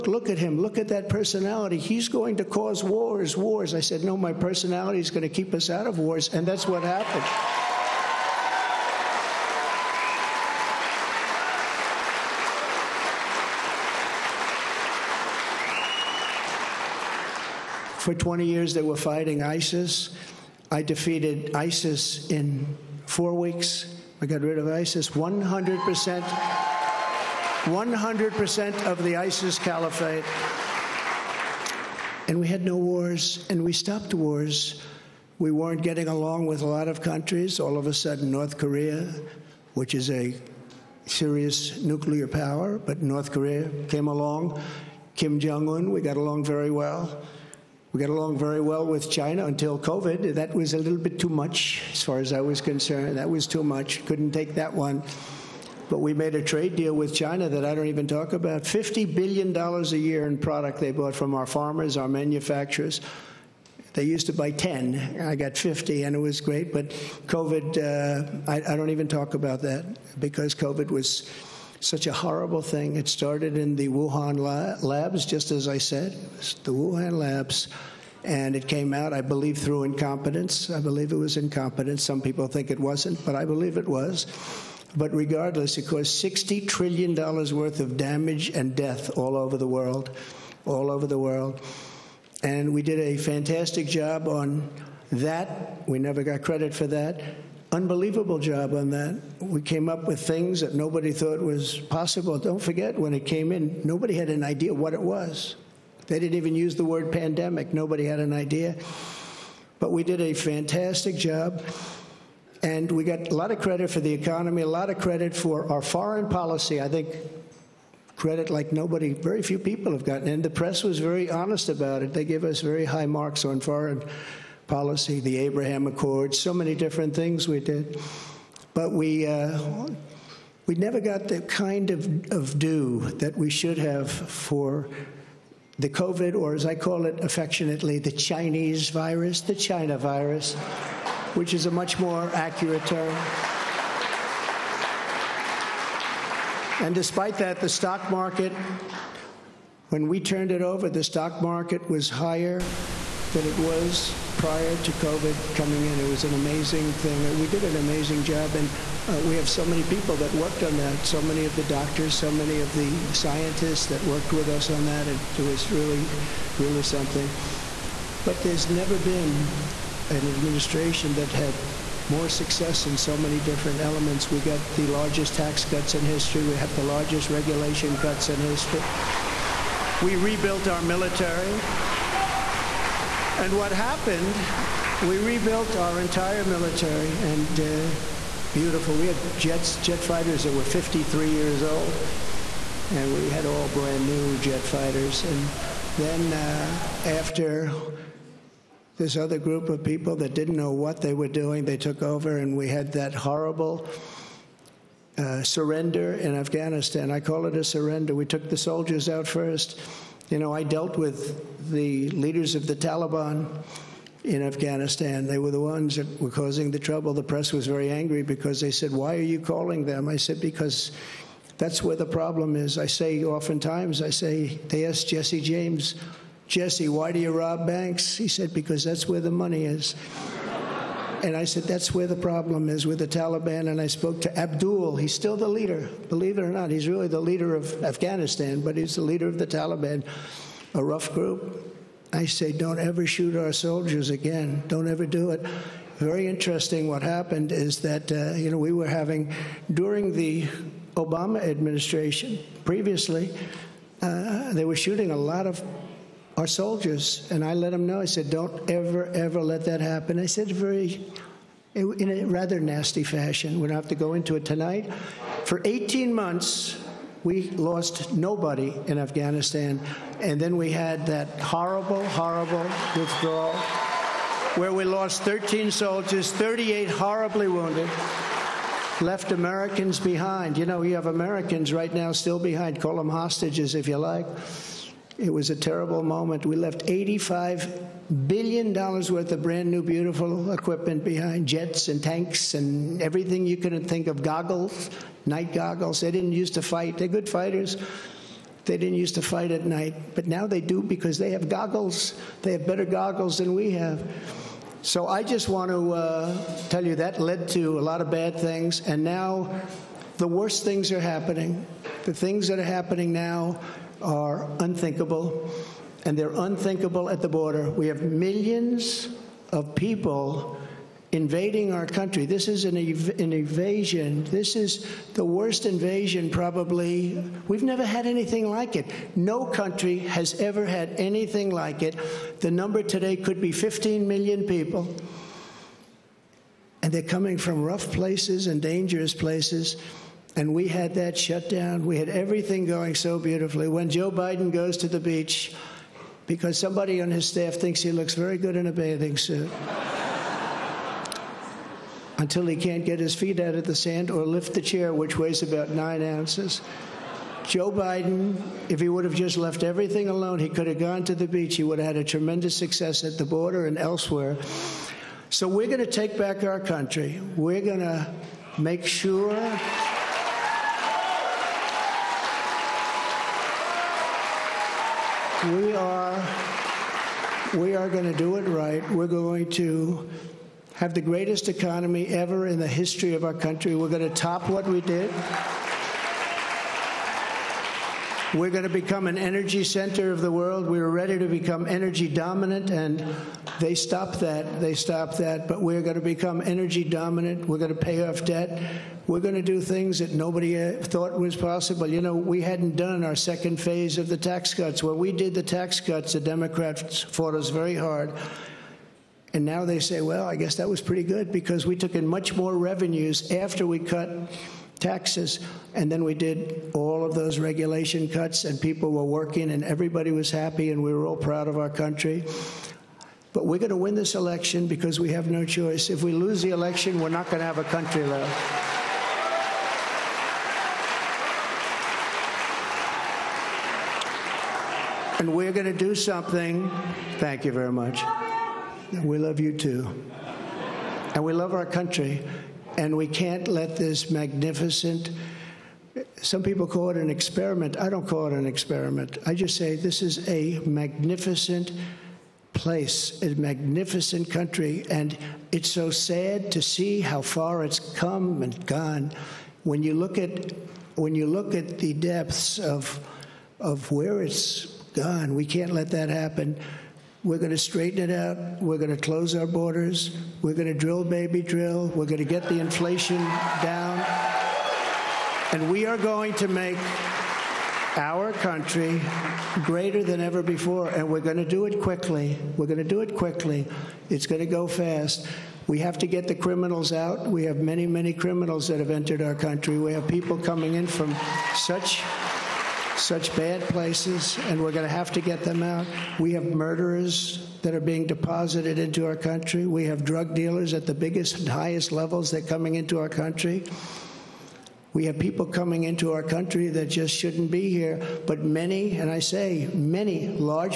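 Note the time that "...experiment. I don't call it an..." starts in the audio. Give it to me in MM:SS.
07:27.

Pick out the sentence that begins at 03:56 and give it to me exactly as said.
He's really the leader of Afghanistan, but he's the leader of the Taliban, a rough group.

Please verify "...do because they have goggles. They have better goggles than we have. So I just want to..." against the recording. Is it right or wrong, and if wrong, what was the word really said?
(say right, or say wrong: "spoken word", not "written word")
right.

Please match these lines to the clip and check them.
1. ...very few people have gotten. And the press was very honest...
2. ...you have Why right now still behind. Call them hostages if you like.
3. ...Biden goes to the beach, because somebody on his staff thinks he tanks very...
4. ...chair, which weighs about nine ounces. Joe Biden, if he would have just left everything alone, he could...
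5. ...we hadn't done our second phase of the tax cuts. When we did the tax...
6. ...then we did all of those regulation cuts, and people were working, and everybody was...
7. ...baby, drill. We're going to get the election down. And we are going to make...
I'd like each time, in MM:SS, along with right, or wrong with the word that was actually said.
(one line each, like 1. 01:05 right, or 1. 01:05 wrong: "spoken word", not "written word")
1. 01:59 right
2. 04:40 wrong: "Americans", not "Why"
3. 05:44 wrong: "looks", not "tanks"
4. 05:54 right
5. 06:42 right
6. 06:55 right
7. 07:51 wrong: "inflation", not "election".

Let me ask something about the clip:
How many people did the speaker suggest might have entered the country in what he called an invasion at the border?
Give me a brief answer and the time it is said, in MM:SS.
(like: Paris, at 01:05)
15 million, at 05:33.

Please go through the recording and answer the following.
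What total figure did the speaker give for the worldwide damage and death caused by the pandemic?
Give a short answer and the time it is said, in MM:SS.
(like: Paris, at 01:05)
$60 trillion, at 01:26.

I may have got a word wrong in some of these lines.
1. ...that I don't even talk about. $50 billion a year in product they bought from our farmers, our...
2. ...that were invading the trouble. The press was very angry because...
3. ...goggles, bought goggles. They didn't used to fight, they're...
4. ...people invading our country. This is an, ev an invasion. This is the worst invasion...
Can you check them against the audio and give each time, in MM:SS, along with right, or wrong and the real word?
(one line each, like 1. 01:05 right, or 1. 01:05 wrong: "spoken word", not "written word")
1. 00:57 right
2. 03:35 wrong: "causing", not "invading"
3. 04:54 wrong: "night", not "bought"
4. 05:19 right.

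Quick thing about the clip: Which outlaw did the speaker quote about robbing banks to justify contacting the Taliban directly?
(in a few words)
Jesse James.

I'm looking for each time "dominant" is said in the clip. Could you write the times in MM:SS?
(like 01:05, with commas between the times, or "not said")
06:32, 06:36.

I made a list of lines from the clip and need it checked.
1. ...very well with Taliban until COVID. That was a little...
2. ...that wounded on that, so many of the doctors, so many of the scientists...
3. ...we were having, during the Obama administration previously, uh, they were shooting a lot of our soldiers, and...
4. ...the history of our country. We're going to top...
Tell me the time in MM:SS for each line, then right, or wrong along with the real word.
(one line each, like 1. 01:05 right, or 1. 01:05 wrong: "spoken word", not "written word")
1. 00:48 wrong: "China", not "Taliban"
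2. 02:40 wrong: "worked", not "wounded"
3. 04:08 right
4. 06:22 right.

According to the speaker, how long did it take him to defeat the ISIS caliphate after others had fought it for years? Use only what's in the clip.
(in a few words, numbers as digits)
4 weeks.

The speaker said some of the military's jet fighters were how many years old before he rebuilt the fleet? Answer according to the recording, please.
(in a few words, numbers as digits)
53 years.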